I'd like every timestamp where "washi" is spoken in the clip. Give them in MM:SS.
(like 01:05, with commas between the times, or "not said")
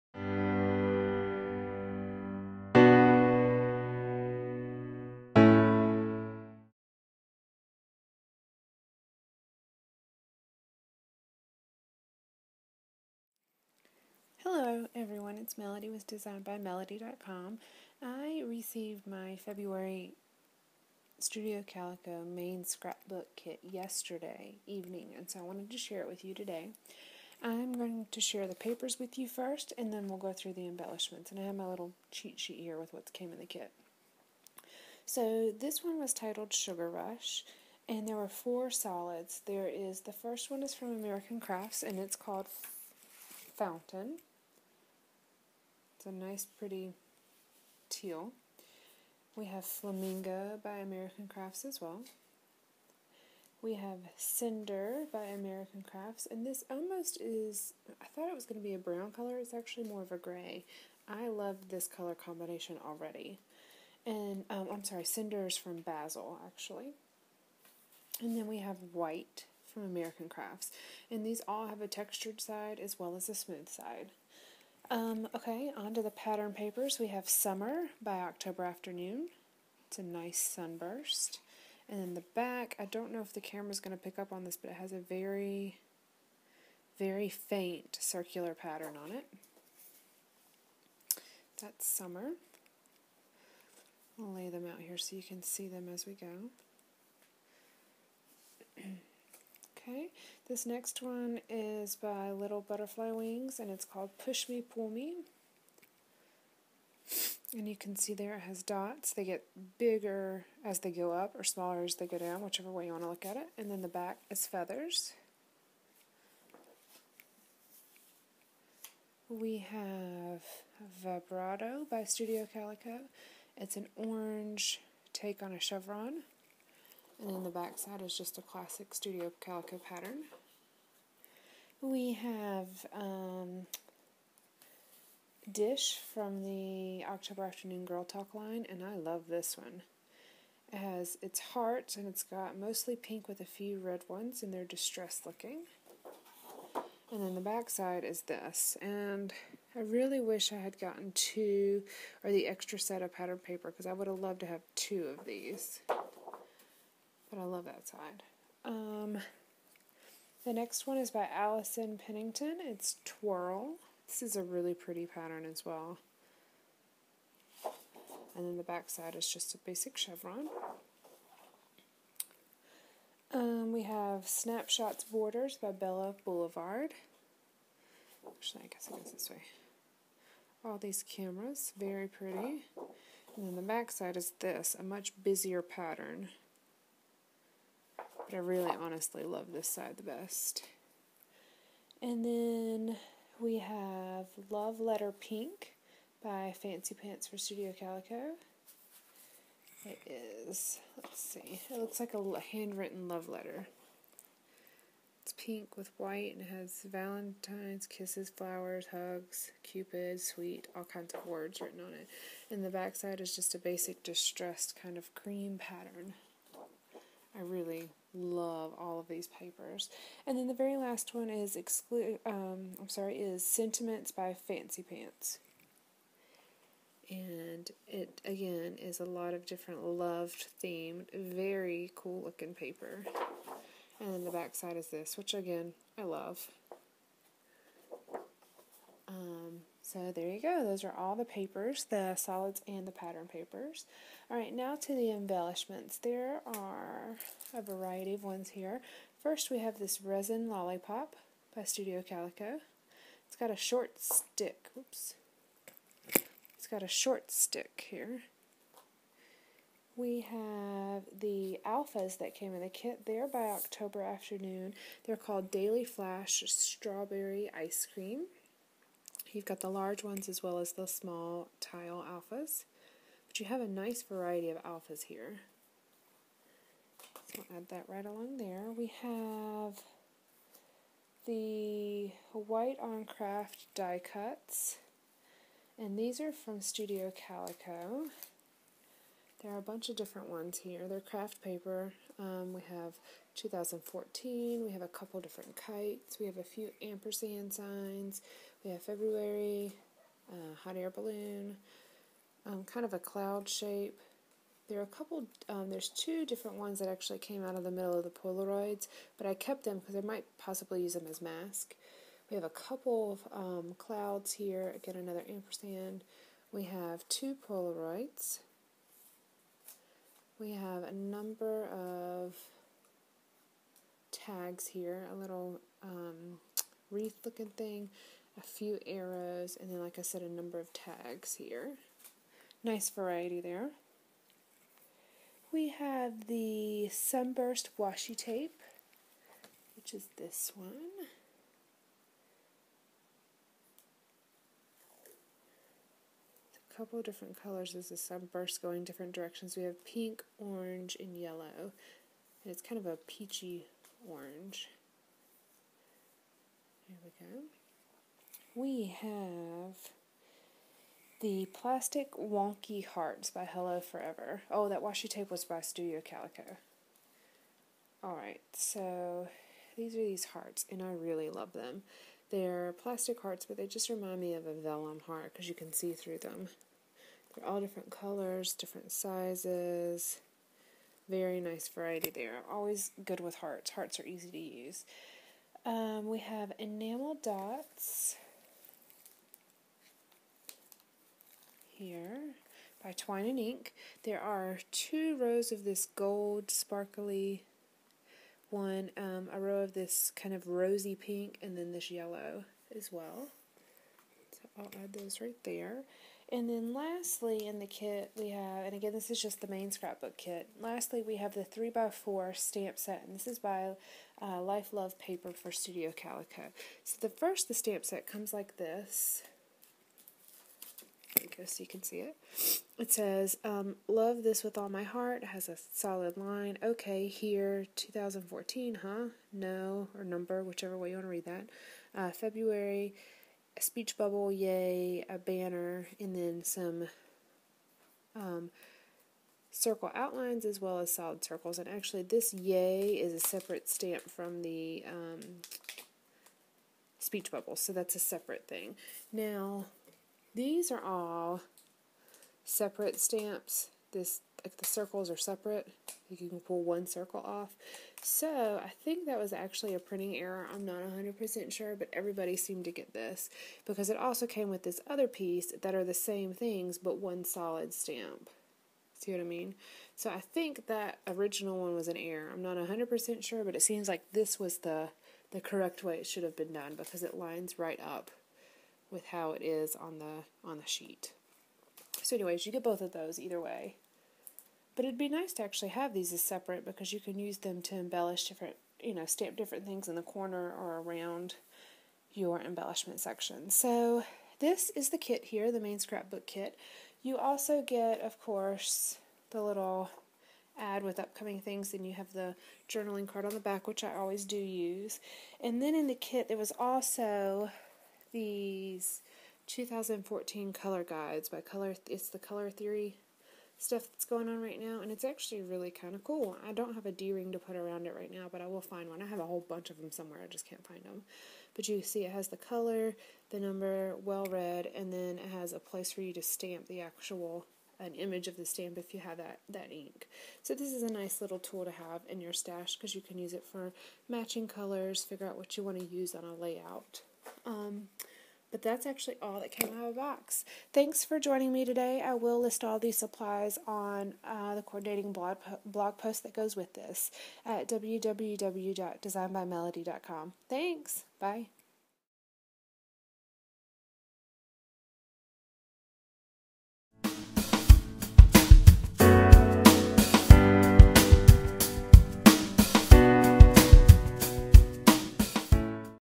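05:37, 06:04.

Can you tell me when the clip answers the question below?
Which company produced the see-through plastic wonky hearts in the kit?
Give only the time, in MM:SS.
06:03.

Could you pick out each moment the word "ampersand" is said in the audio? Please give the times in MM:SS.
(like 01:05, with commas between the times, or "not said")
04:56, 05:15.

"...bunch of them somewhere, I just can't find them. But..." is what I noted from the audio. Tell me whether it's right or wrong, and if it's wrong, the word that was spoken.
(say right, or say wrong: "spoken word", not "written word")
right.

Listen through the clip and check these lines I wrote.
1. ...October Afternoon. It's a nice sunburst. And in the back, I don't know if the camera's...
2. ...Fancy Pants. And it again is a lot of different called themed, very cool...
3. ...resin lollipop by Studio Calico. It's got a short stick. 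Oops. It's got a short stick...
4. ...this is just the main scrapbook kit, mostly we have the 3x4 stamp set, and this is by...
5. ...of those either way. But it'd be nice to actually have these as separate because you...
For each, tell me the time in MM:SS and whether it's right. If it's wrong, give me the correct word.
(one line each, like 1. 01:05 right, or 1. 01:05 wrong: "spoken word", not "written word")
1. 01:18 right
2. 03:44 wrong: "loved", not "called"
3. 04:10 right
4. 06:48 wrong: "lastly", not "mostly"
5. 08:02 right.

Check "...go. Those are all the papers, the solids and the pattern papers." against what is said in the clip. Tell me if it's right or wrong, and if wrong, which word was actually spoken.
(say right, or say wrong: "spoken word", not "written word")
right.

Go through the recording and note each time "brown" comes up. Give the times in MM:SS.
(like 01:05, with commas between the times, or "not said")
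00:58.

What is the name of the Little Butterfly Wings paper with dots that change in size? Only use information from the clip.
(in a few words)
Push Me, Pull Me.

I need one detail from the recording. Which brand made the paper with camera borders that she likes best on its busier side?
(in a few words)
Bella Boulevard.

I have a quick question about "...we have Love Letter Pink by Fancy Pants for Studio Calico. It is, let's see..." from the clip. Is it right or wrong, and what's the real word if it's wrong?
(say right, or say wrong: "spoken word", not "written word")
right.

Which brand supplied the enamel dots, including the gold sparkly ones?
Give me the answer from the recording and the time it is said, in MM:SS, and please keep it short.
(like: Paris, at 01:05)
Twine and Ink, at 06:32.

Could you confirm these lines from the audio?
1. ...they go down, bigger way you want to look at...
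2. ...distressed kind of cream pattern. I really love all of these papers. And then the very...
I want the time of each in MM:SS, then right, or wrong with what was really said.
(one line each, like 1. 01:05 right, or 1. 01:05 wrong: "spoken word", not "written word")
1. 01:51 wrong: "whichever", not "bigger"
2. 03:34 right.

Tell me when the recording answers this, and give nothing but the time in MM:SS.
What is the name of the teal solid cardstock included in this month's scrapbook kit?
00:43.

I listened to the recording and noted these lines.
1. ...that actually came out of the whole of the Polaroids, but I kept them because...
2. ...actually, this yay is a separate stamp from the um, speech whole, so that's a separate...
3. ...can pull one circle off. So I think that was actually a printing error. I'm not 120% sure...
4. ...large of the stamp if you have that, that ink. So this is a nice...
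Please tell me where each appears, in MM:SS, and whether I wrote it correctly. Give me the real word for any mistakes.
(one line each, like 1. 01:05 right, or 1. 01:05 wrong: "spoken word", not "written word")
1. 05:06 wrong: "middle", not "whole"
2. 07:21 wrong: "bubble", not "whole"
3. 07:36 wrong: "100", not "120"
4. 08:47 wrong: "image", not "large".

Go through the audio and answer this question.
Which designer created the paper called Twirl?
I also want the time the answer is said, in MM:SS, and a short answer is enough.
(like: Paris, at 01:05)
Allison Pennington, at 02:41.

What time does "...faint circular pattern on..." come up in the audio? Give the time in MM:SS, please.
01:27.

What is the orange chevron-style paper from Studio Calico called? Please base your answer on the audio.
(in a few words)
Vibrato.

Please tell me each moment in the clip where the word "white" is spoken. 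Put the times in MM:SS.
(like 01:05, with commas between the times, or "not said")
01:08, 03:25, 04:42.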